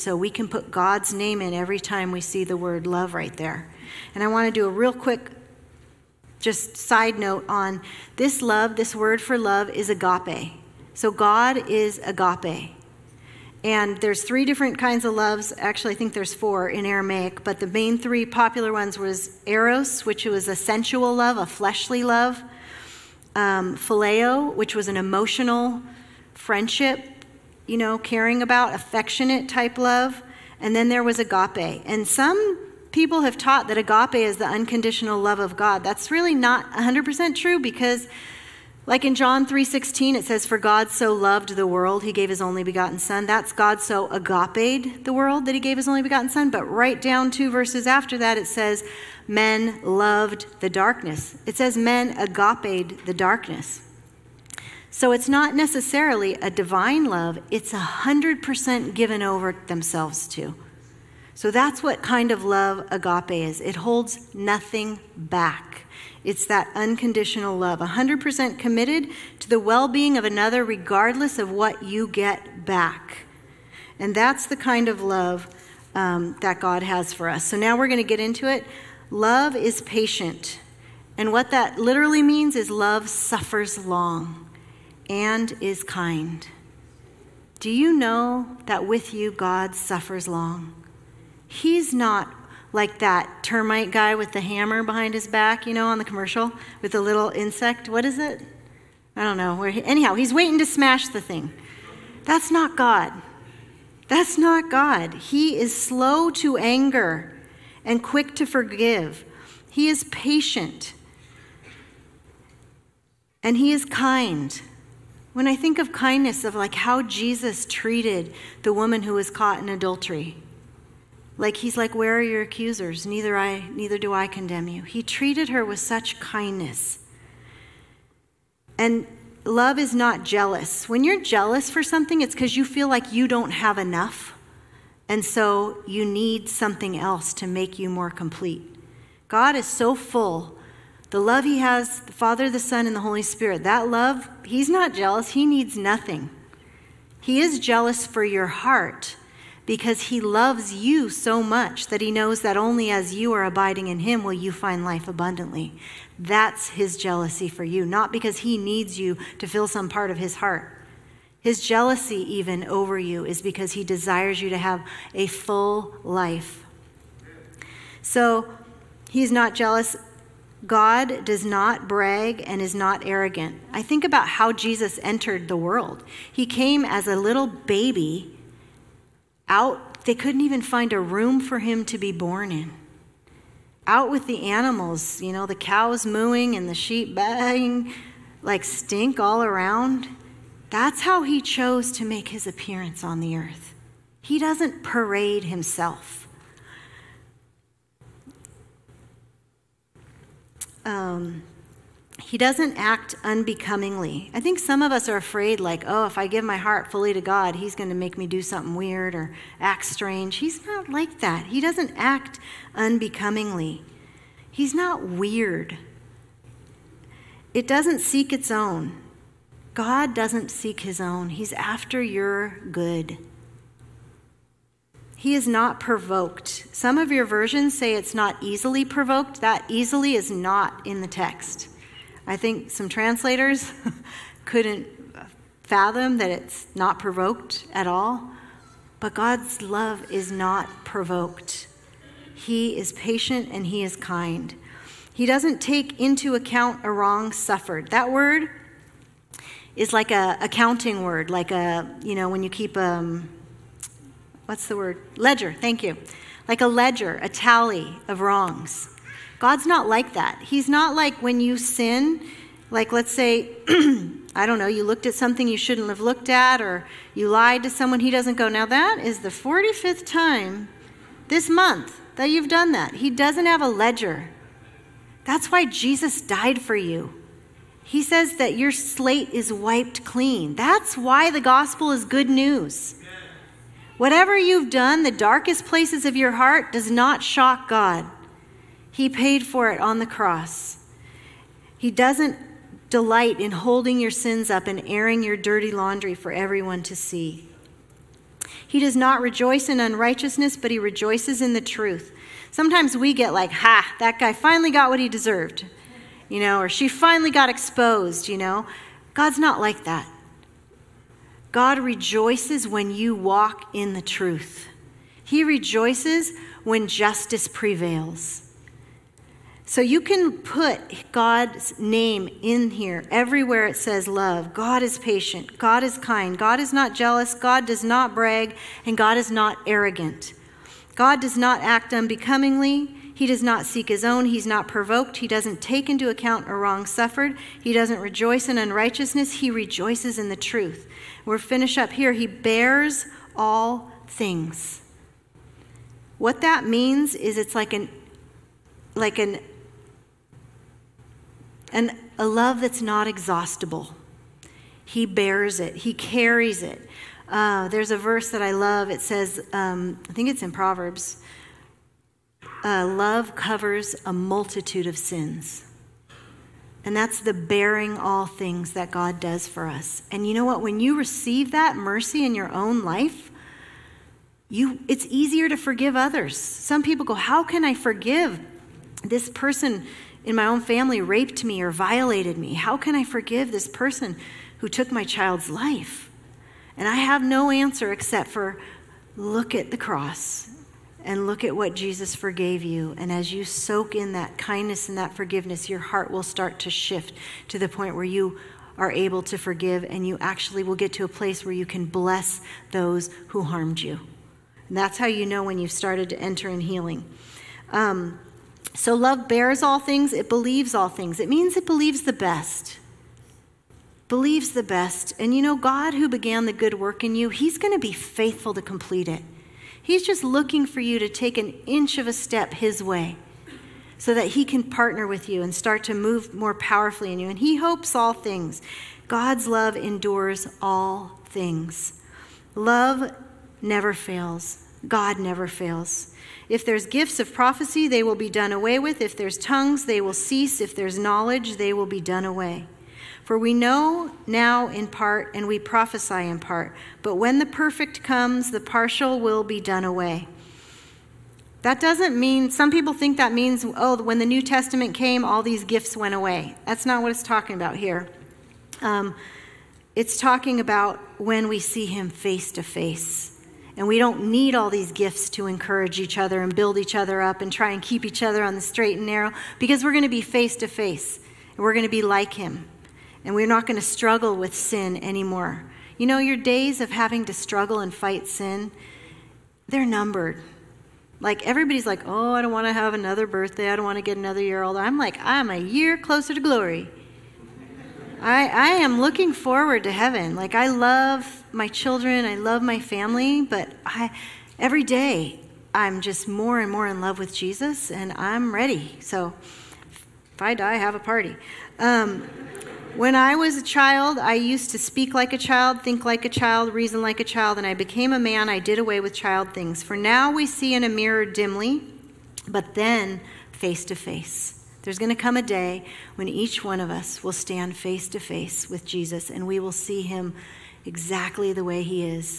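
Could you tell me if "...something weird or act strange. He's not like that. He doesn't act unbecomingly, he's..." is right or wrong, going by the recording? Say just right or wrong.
right.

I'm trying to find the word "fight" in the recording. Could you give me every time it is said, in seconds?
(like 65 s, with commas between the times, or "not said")
477 s.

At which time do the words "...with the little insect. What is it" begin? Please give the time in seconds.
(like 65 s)
96 s.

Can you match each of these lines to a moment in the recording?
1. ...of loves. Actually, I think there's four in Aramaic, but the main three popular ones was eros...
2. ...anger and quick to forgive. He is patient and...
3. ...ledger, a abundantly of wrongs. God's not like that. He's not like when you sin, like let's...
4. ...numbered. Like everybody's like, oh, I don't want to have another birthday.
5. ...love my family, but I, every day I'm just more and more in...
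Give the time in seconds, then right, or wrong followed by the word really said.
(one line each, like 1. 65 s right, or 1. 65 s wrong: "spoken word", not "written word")
1. 15 s right
2. 106 s right
3. 256 s wrong: "tally", not "abundantly"
4. 479 s right
5. 492 s right.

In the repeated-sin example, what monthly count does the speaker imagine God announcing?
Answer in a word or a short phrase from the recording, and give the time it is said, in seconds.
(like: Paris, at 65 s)
45th time, at 269 s.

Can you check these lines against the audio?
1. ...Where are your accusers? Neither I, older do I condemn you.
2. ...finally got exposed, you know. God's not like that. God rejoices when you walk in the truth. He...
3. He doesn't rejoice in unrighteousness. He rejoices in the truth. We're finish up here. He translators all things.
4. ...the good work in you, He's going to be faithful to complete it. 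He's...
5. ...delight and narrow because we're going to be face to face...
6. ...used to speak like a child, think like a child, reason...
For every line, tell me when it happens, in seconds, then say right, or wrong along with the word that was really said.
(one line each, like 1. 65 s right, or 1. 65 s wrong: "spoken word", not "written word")
1. 121 s wrong: "neither", not "older"
2. 306 s right
3. 337 s wrong: "bears", not "translators"
4. 416 s right
5. 468 s wrong: "straight", not "delight"
6. 504 s right.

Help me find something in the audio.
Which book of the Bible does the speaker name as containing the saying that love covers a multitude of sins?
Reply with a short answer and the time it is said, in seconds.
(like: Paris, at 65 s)
Proverbs, at 360 s.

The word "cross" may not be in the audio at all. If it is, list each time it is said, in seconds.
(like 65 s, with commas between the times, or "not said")
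290 s, 389 s.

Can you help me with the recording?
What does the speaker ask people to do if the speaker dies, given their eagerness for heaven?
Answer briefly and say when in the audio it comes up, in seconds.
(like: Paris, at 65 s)
have a party, at 500 s.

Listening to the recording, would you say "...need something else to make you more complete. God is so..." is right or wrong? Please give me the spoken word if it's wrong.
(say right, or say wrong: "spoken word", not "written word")
right.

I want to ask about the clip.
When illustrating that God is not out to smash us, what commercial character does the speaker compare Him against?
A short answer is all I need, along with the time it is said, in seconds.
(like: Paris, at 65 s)
termite guy, at 93 s.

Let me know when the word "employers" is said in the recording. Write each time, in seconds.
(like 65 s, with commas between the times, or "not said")
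not said.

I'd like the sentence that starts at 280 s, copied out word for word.
That's why the gospel is good news.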